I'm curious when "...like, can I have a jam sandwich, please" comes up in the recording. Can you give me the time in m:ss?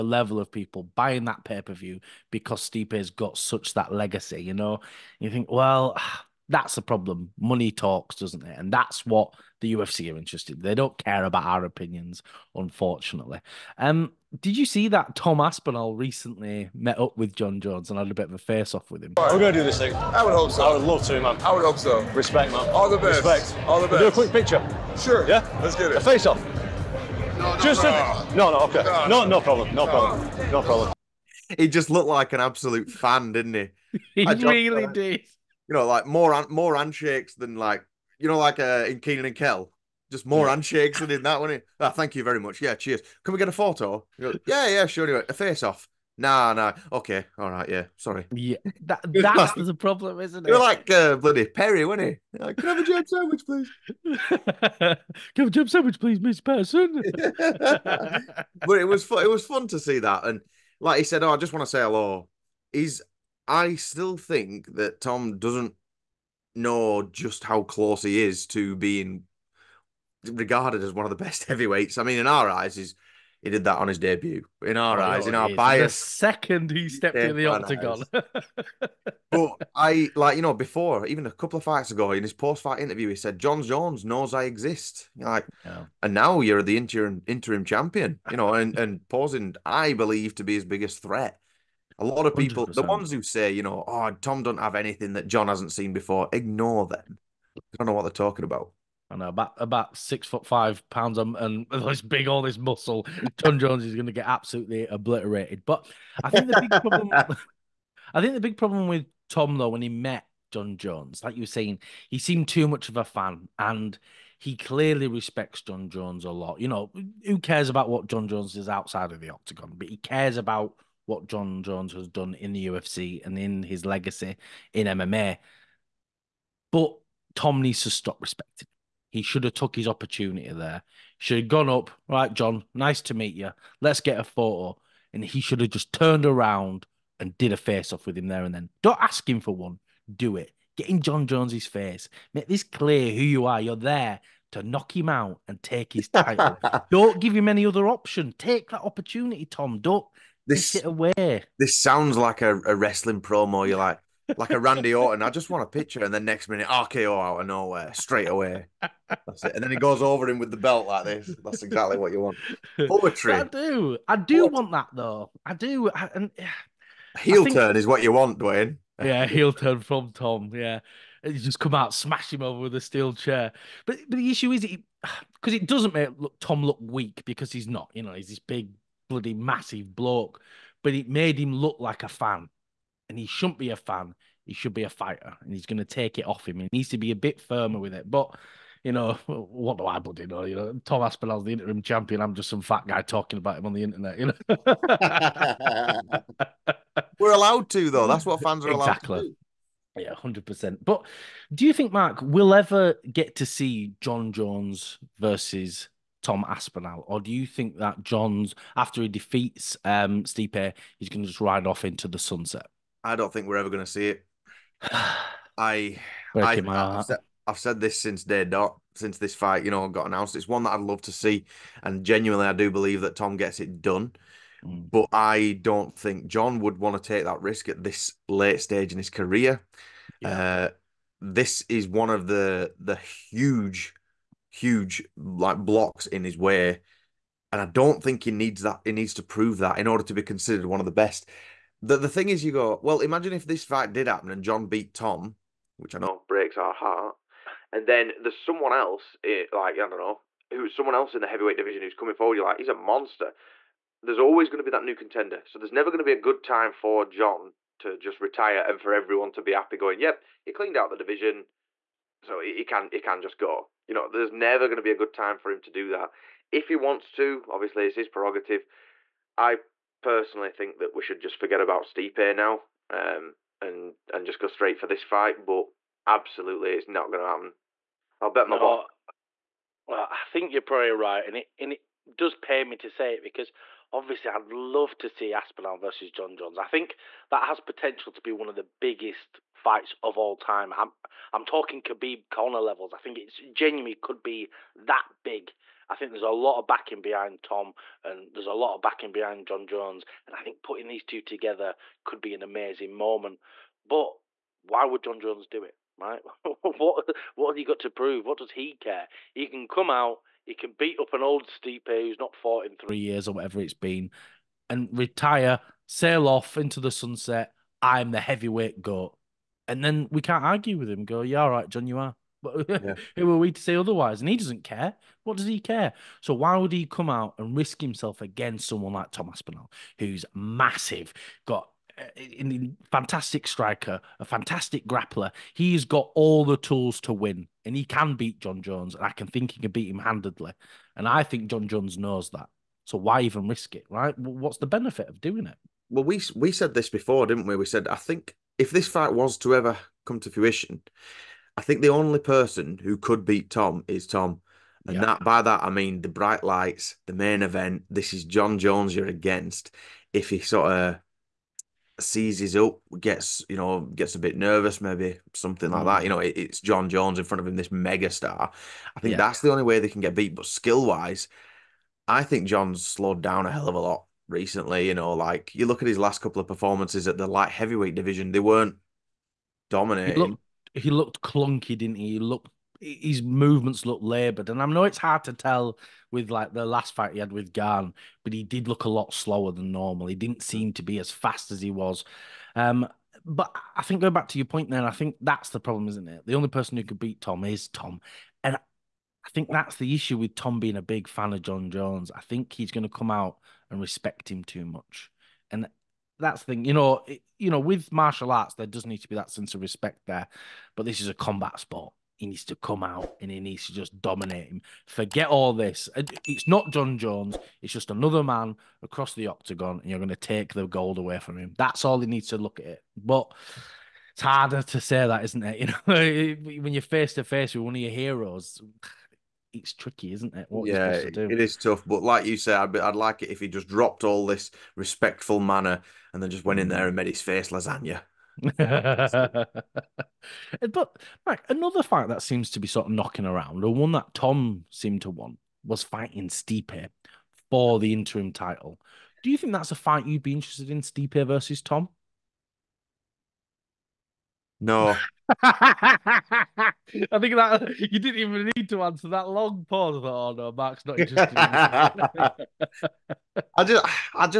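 0:52.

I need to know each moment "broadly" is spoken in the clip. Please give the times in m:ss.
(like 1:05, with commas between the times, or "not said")
not said.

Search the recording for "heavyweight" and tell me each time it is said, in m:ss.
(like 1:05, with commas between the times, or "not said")
1:11, 4:11, 5:18, 6:17.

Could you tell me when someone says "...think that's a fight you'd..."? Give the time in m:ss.
7:29.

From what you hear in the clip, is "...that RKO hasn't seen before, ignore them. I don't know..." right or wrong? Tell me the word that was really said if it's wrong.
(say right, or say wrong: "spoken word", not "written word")
wrong: "Jon", not "RKO".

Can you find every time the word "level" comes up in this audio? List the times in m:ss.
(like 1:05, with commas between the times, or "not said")
0:00, 4:52.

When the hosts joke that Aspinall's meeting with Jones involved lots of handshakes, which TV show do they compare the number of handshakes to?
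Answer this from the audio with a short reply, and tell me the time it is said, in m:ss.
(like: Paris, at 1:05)
Kenan and Kel, at 0:39.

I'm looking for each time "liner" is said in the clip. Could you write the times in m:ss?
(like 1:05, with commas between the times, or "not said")
not said.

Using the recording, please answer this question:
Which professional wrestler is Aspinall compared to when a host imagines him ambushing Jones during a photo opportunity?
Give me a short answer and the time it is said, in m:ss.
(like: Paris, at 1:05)
Randy Orton, at 2:34.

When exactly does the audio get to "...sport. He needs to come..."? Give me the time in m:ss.
6:51.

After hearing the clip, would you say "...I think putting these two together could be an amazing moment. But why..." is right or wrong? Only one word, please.
right.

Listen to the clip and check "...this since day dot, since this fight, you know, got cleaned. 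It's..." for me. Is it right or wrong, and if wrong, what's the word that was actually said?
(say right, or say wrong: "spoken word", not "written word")
wrong: "announced", not "cleaned".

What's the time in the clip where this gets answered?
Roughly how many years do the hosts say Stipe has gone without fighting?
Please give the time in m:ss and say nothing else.
5:12.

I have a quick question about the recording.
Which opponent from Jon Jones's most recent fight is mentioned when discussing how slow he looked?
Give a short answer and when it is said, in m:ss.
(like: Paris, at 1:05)
Gane, at 6:27.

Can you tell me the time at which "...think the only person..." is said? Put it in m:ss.
5:51.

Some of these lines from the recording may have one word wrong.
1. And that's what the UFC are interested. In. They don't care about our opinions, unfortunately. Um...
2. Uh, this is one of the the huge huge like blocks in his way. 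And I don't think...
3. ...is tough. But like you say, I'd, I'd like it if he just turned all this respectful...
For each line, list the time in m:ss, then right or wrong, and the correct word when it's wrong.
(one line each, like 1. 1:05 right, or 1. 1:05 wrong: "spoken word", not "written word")
1. 0:08 right
2. 3:50 right
3. 7:11 wrong: "dropped", not "turned".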